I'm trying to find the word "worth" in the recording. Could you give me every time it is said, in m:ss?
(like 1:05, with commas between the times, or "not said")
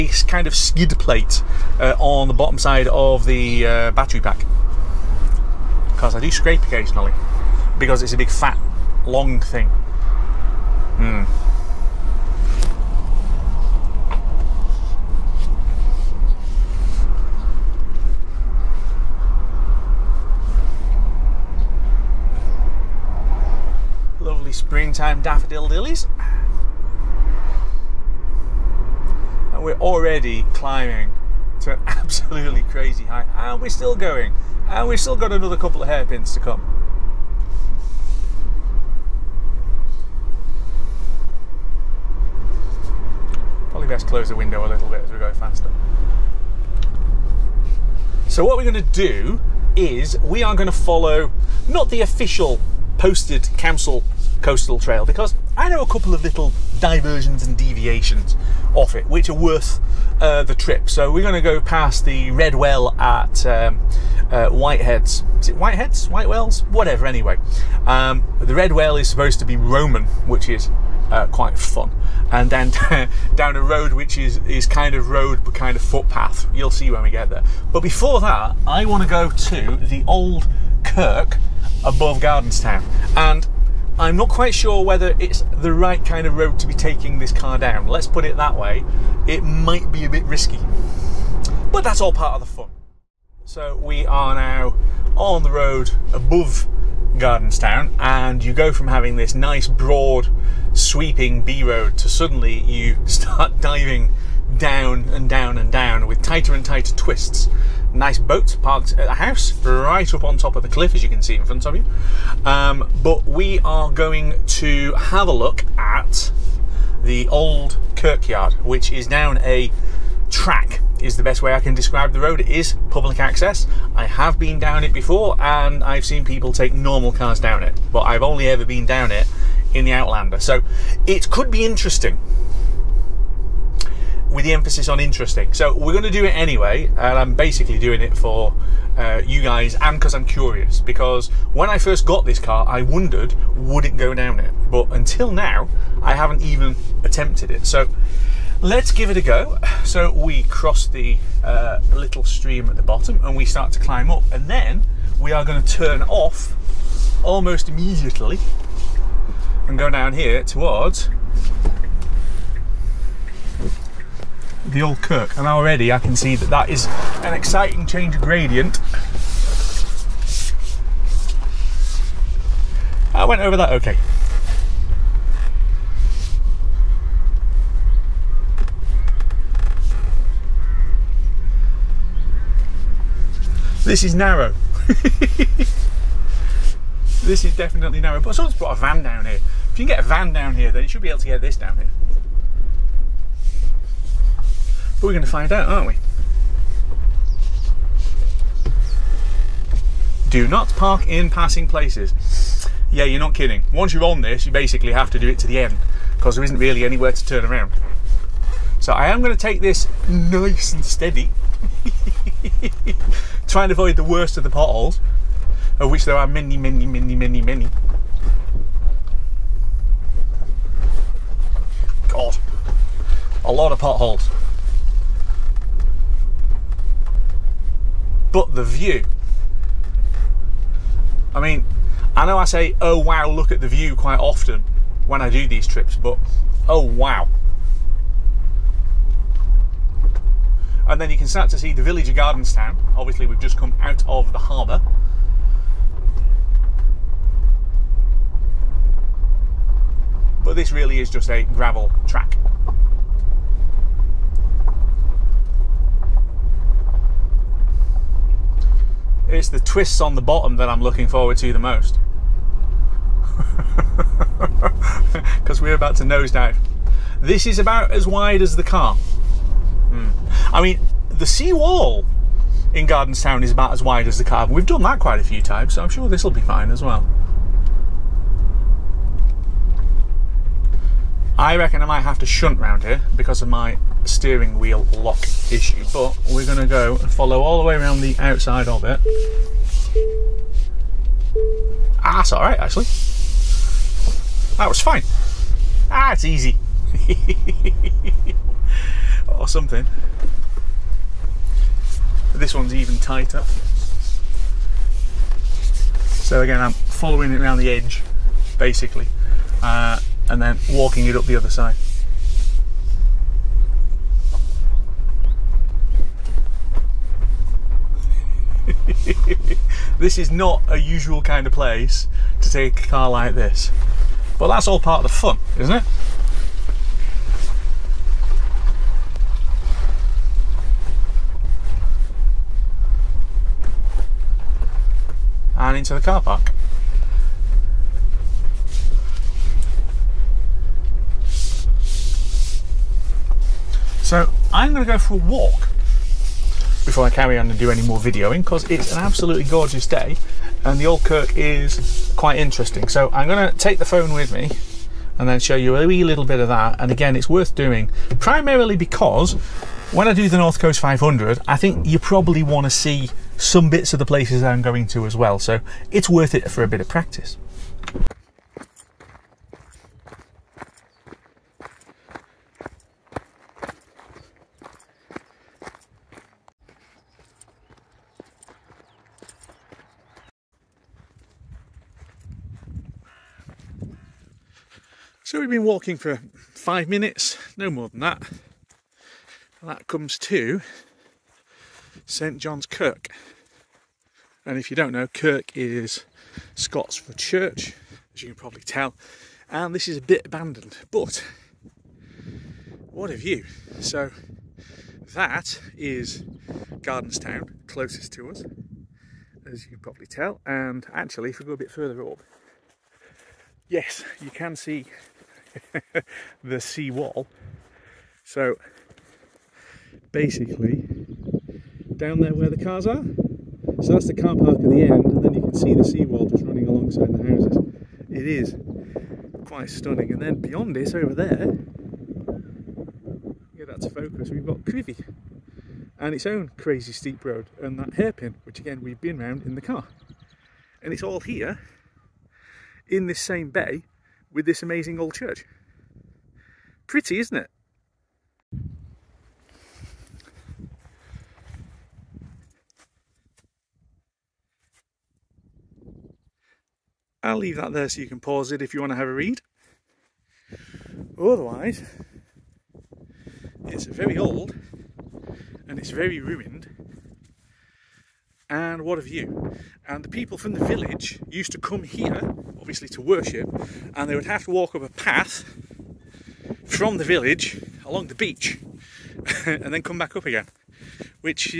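0:59, 5:57, 6:06.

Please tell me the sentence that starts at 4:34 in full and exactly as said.
We've done that quite a few times, so I'm sure this will be fine as well.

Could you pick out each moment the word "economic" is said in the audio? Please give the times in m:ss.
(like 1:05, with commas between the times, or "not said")
not said.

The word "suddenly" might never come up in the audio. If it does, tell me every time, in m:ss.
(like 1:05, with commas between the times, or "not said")
1:42.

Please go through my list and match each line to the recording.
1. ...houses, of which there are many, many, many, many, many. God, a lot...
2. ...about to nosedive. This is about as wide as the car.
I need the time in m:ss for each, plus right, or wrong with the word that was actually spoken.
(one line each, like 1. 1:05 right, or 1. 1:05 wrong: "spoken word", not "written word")
1. 3:34 wrong: "potholes", not "houses"
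2. 4:25 right.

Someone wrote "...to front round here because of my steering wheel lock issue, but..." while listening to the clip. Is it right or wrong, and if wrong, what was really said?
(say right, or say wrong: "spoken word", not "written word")
wrong: "shunt", not "front".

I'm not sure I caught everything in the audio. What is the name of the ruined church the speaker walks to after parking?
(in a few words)
St John's Kirk.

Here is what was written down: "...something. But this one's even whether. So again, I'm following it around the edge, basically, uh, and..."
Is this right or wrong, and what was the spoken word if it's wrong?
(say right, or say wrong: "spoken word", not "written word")
wrong: "tighter", not "whether".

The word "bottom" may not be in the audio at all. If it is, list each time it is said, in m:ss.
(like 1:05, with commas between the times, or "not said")
0:02, 2:32, 4:20.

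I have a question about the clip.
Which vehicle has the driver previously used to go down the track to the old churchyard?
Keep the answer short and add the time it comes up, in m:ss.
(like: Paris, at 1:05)
Outlander, at 2:09.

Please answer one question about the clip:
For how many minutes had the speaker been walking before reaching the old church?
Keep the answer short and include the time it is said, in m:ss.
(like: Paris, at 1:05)
5, at 6:26.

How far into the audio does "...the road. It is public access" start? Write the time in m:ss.
2:02.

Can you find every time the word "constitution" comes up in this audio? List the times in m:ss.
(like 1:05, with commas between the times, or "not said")
not said.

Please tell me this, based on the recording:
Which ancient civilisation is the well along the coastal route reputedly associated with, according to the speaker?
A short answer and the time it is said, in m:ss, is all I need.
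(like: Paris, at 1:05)
Roman, at 1:09.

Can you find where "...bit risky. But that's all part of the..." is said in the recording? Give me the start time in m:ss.
1:30.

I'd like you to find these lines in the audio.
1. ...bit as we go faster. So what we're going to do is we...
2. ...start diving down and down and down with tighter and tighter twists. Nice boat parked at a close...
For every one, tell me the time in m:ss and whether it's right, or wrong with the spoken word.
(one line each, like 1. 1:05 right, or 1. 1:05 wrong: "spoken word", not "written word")
1. 0:44 right
2. 1:43 wrong: "house", not "close".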